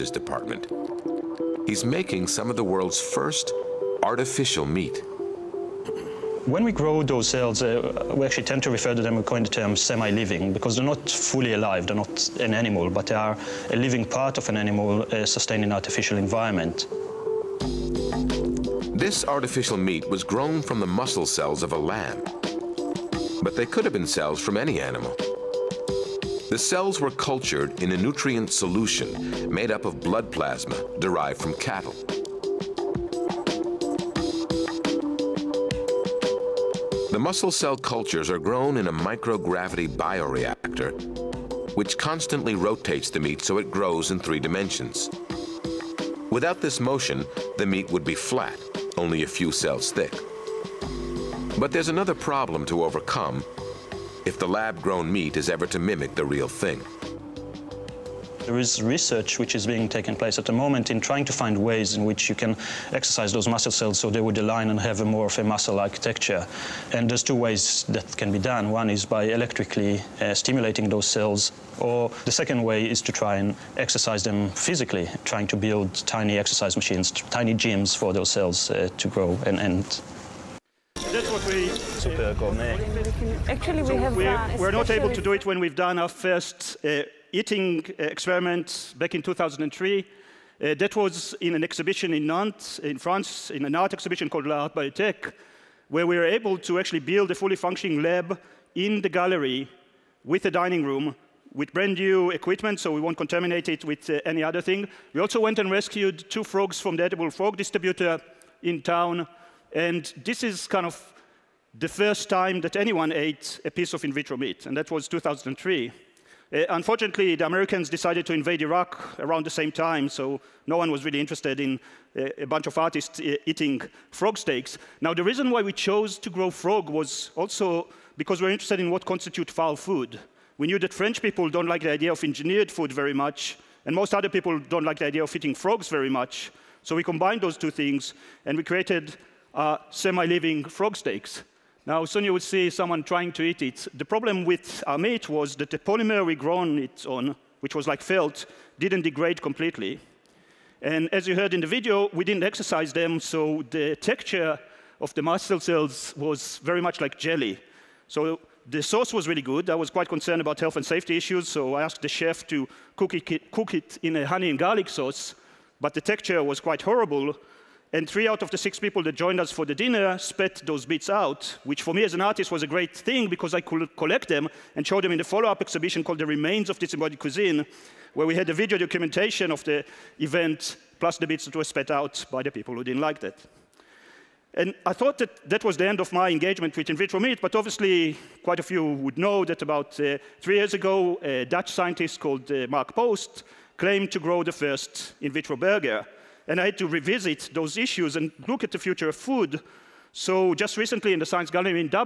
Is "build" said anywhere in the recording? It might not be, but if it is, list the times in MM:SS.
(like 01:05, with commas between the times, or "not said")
01:15, 01:36.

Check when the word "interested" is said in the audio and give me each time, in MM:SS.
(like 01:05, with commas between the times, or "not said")
02:01, 02:08.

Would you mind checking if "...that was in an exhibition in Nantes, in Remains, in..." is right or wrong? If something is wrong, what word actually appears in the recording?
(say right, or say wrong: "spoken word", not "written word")
wrong: "France", not "Remains".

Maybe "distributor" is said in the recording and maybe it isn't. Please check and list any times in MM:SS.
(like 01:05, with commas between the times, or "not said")
01:47.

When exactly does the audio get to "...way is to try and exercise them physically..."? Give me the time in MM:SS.
01:12.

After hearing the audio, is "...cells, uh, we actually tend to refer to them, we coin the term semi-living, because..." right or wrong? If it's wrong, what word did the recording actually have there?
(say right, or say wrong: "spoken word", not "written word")
right.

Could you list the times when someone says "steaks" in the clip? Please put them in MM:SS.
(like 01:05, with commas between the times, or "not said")
02:04, 02:20.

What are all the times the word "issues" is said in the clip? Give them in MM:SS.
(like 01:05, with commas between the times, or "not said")
02:41, 03:17.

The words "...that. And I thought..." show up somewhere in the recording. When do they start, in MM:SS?
03:03.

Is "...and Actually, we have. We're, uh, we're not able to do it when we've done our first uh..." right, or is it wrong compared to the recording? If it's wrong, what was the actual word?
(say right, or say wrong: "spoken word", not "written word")
right.